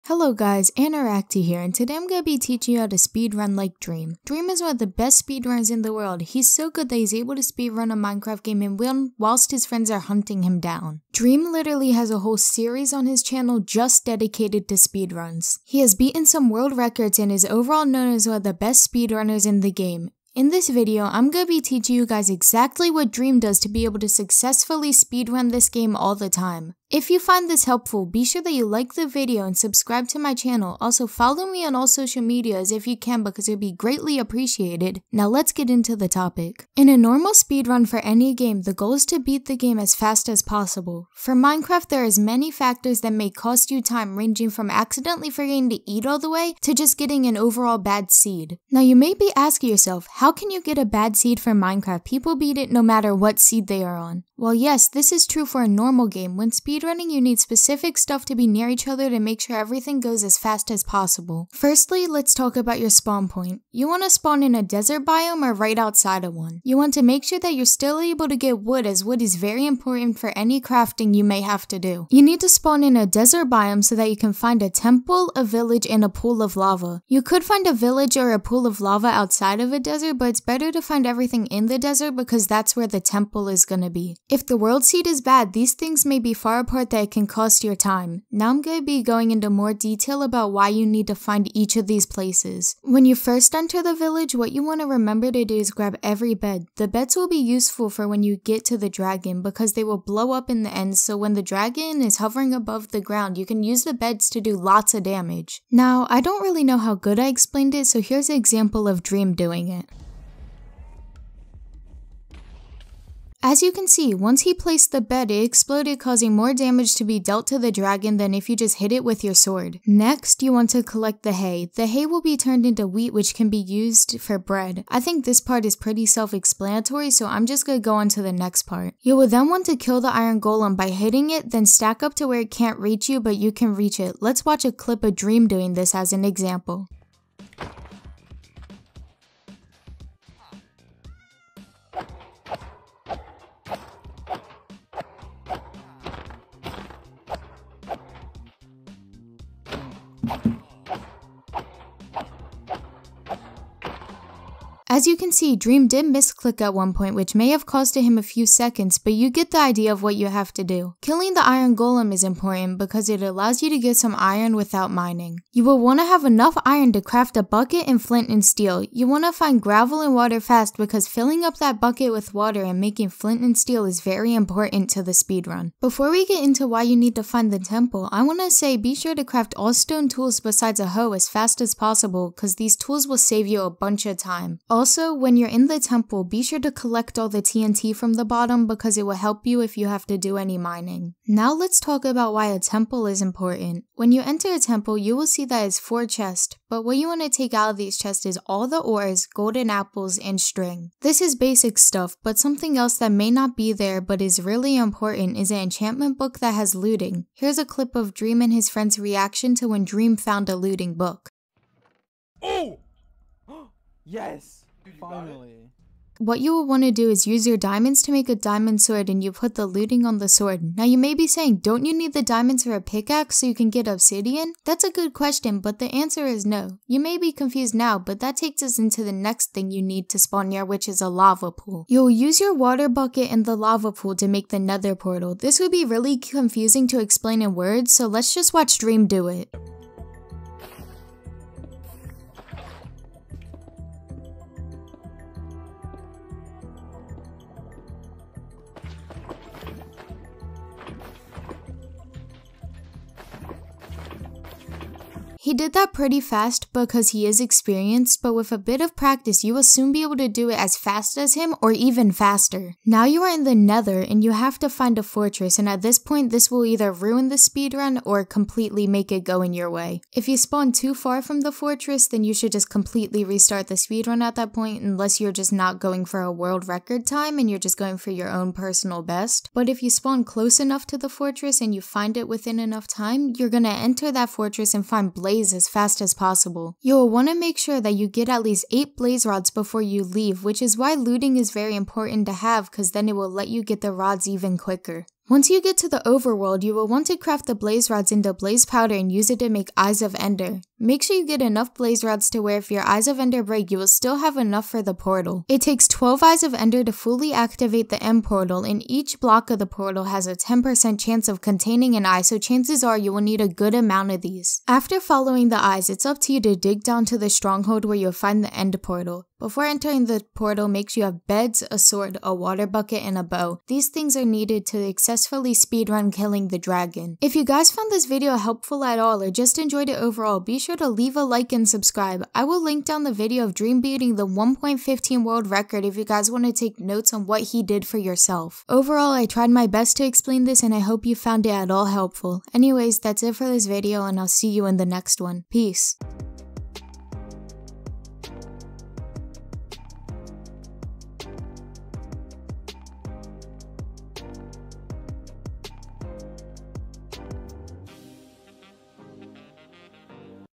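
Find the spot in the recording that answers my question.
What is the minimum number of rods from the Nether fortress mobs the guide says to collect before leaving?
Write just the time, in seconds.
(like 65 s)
288 s.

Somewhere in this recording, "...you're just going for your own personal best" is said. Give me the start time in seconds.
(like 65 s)
277 s.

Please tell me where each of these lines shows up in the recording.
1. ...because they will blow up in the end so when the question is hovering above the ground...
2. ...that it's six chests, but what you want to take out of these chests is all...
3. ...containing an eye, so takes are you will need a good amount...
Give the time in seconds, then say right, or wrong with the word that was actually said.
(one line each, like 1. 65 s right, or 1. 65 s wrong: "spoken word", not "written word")
1. 99 s wrong: "dragon", not "question"
2. 195 s wrong: "four", not "six"
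3. 311 s wrong: "chances", not "takes".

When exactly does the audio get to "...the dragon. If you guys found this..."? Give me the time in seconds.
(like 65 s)
326 s.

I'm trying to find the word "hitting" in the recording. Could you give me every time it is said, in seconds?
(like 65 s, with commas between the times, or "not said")
130 s.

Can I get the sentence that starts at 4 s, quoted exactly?
Dream is one of the best speedrunners in the world.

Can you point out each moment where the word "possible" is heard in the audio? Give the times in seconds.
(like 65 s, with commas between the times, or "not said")
40 s, 60 s, 181 s, 286 s.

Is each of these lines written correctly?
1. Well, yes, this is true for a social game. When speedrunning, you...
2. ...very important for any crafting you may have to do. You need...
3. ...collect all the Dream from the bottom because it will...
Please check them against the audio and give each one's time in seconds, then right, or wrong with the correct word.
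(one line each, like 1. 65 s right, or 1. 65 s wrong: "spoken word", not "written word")
1. 54 s wrong: "normal", not "social"
2. 69 s right
3. 186 s wrong: "TNT", not "Dream".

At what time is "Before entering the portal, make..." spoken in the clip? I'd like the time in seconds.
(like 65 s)
319 s.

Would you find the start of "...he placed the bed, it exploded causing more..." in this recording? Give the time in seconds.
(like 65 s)
114 s.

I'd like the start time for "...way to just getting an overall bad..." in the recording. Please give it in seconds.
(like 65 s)
46 s.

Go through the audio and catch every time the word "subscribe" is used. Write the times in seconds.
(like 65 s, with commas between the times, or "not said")
29 s, 331 s.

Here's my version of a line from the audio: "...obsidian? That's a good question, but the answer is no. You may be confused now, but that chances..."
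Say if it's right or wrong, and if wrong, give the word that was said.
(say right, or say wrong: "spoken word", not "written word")
wrong: "takes", not "chances".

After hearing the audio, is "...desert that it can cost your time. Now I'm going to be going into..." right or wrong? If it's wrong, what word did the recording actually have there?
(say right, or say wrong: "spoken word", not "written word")
wrong: "apart", not "desert".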